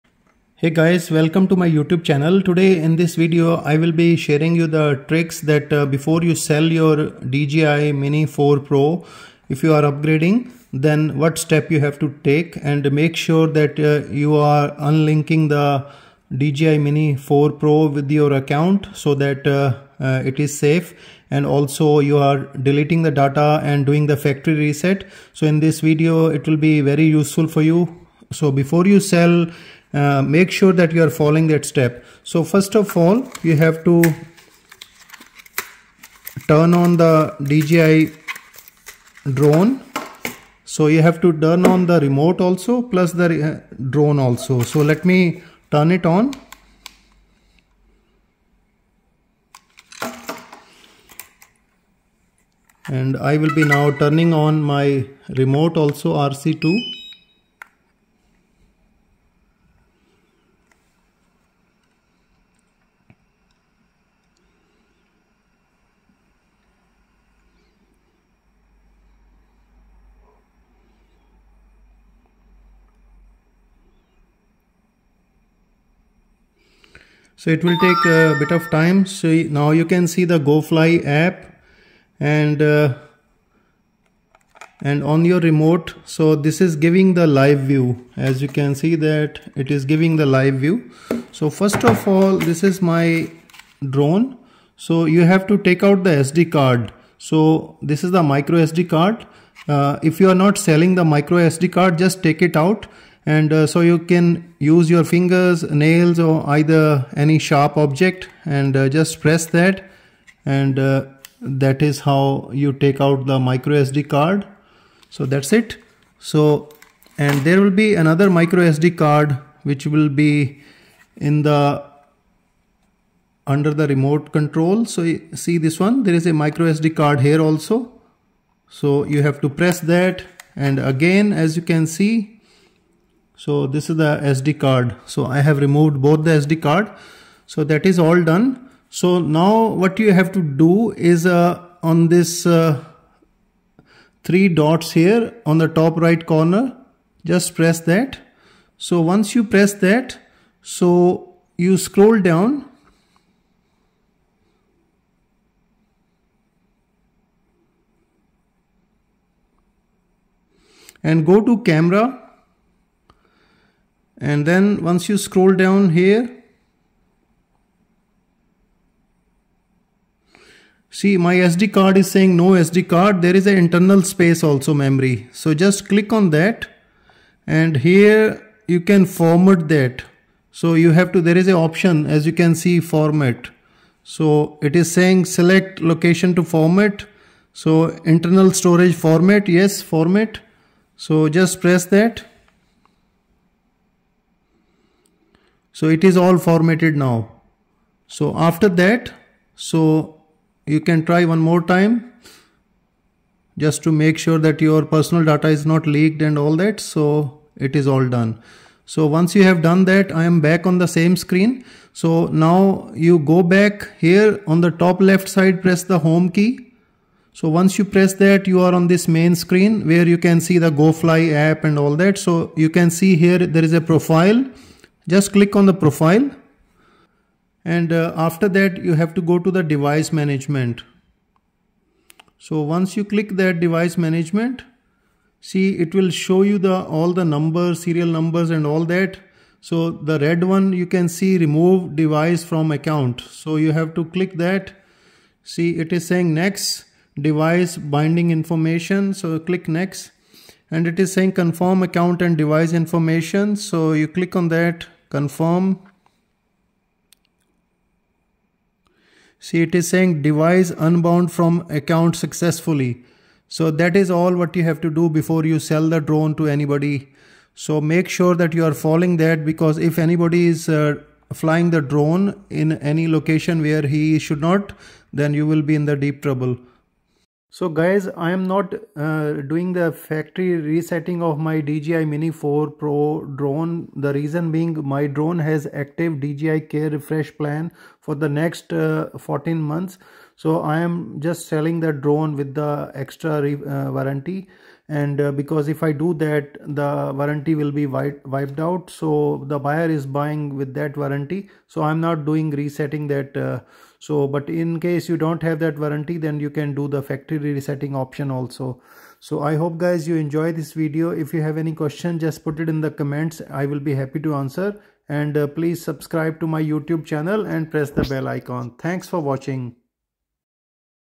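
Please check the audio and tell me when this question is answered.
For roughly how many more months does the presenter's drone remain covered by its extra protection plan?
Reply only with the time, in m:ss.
4:49.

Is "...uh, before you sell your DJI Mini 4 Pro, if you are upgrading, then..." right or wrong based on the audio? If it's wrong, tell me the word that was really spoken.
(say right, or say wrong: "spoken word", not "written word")
right.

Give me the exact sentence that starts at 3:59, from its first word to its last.
So the red one you can see remove device from account.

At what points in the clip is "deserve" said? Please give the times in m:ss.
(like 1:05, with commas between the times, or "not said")
not said.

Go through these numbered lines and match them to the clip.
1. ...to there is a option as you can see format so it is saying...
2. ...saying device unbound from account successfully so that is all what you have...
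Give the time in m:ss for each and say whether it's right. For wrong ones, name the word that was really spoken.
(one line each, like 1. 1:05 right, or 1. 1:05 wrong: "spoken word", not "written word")
1. 3:01 right
2. 4:19 right.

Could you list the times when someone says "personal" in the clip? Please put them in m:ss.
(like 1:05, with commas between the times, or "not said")
3:24.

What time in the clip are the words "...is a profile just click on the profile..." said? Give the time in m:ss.
3:43.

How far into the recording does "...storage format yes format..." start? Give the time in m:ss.
3:08.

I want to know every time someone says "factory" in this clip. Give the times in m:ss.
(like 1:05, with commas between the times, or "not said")
0:24, 4:39, 5:07.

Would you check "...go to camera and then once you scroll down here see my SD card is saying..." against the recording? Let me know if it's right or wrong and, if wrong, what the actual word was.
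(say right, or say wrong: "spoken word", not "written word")
right.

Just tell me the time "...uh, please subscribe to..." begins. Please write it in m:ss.
5:15.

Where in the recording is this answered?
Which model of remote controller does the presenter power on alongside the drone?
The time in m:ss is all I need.
0:56.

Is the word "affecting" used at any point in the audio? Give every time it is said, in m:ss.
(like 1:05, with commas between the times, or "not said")
not said.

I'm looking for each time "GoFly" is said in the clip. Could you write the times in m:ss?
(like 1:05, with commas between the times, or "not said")
1:20, 3:40.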